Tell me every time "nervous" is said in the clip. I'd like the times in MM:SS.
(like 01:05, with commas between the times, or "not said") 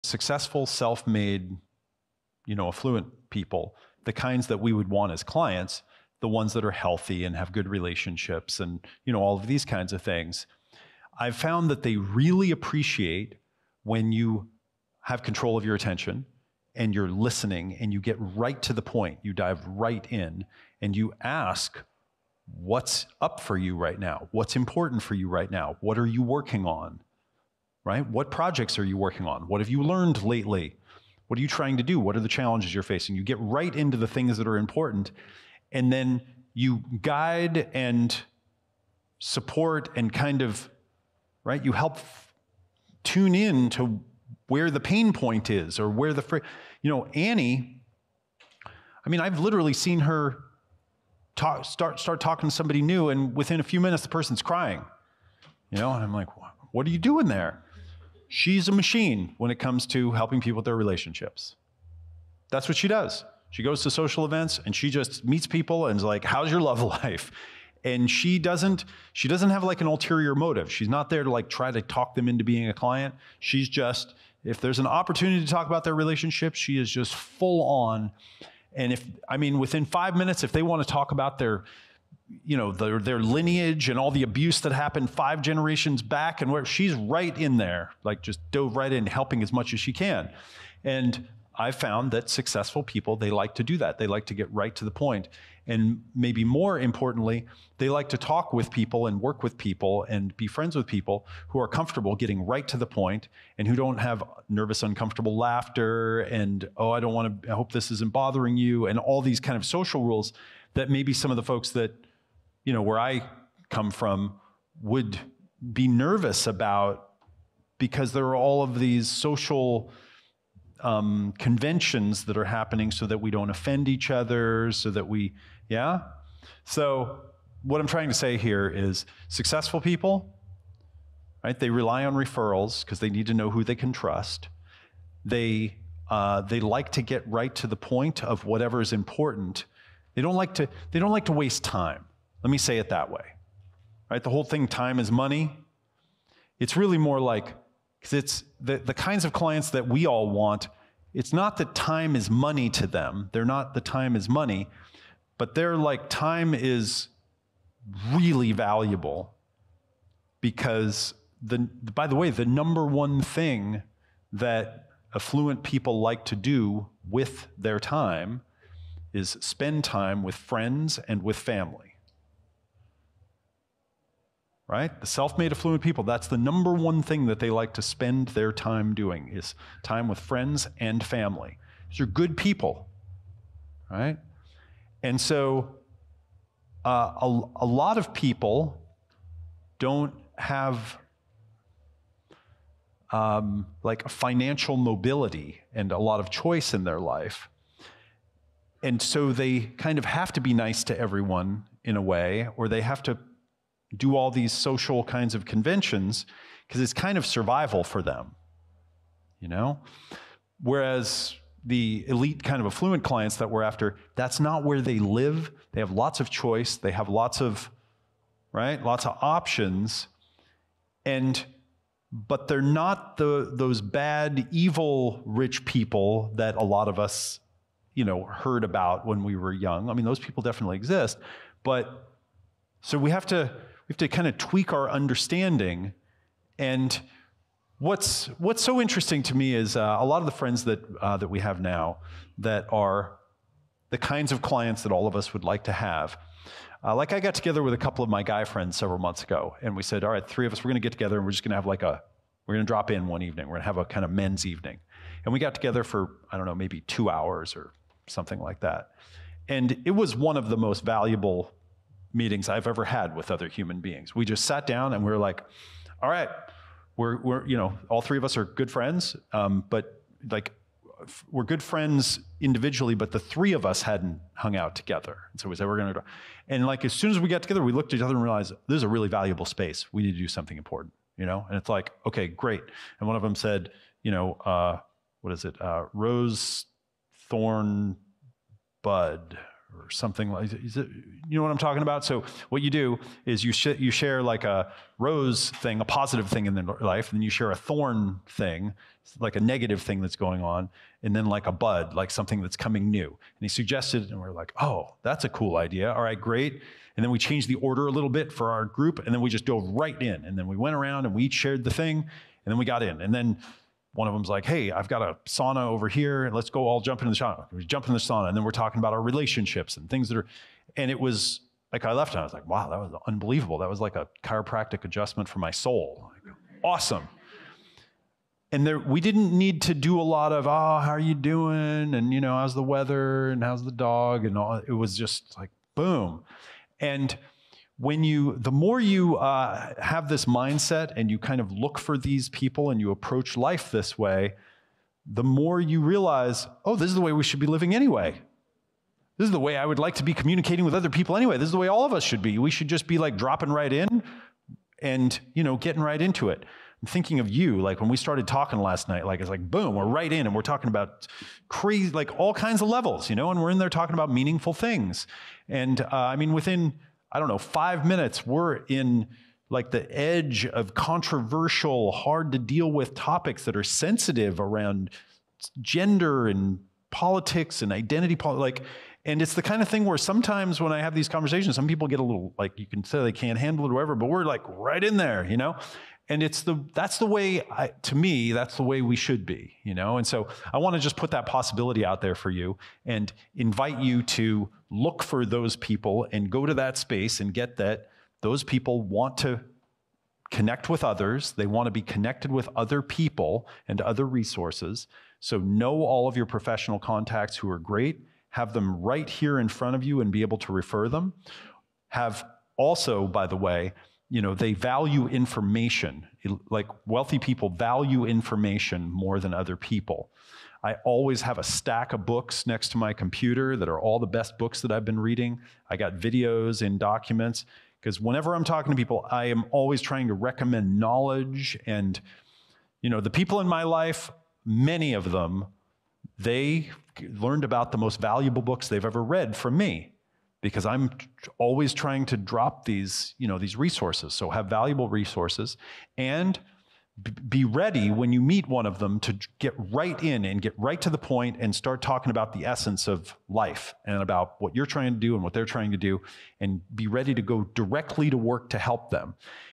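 01:44, 01:55.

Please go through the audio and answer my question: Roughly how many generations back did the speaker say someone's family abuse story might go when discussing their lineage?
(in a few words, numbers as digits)
5.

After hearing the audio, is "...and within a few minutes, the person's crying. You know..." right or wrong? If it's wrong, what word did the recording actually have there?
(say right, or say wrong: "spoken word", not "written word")
right.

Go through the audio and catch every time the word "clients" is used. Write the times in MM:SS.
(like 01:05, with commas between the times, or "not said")
00:05, 01:12, 02:29, 03:33, 04:04.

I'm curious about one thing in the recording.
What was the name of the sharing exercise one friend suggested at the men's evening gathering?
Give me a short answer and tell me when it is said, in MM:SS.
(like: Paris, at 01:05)
Rose Thorn Bud, at 04:45.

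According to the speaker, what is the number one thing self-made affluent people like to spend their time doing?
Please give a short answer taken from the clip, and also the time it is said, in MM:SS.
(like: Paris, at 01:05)
Time with friends and family, at 02:59.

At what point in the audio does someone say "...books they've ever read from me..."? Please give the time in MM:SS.
07:18.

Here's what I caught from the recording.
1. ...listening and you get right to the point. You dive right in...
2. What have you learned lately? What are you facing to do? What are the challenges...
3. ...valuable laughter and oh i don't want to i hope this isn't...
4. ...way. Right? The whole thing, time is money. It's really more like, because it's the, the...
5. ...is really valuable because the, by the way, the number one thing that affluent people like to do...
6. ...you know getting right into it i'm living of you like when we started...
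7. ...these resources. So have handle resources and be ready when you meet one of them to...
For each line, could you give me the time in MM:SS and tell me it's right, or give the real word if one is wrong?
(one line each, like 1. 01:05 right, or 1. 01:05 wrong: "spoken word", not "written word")
1. 00:17 right
2. 00:29 wrong: "trying", not "facing"
3. 01:44 wrong: "uncomfortable", not "valuable"
4. 02:23 right
5. 02:36 right
6. 05:55 wrong: "thinking", not "living"
7. 07:23 wrong: "valuable", not "handle".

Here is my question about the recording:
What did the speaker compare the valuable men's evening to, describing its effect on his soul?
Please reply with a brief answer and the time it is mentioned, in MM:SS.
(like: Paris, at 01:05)
A chiropractic adjustment, at 05:24.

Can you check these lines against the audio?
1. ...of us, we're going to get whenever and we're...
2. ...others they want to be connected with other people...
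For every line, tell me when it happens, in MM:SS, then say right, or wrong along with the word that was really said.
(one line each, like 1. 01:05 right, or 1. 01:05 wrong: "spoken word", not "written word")
1. 04:10 wrong: "together", not "whenever"
2. 06:40 right.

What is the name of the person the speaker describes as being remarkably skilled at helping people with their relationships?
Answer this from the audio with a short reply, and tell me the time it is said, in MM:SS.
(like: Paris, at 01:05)
Annie, at 00:47.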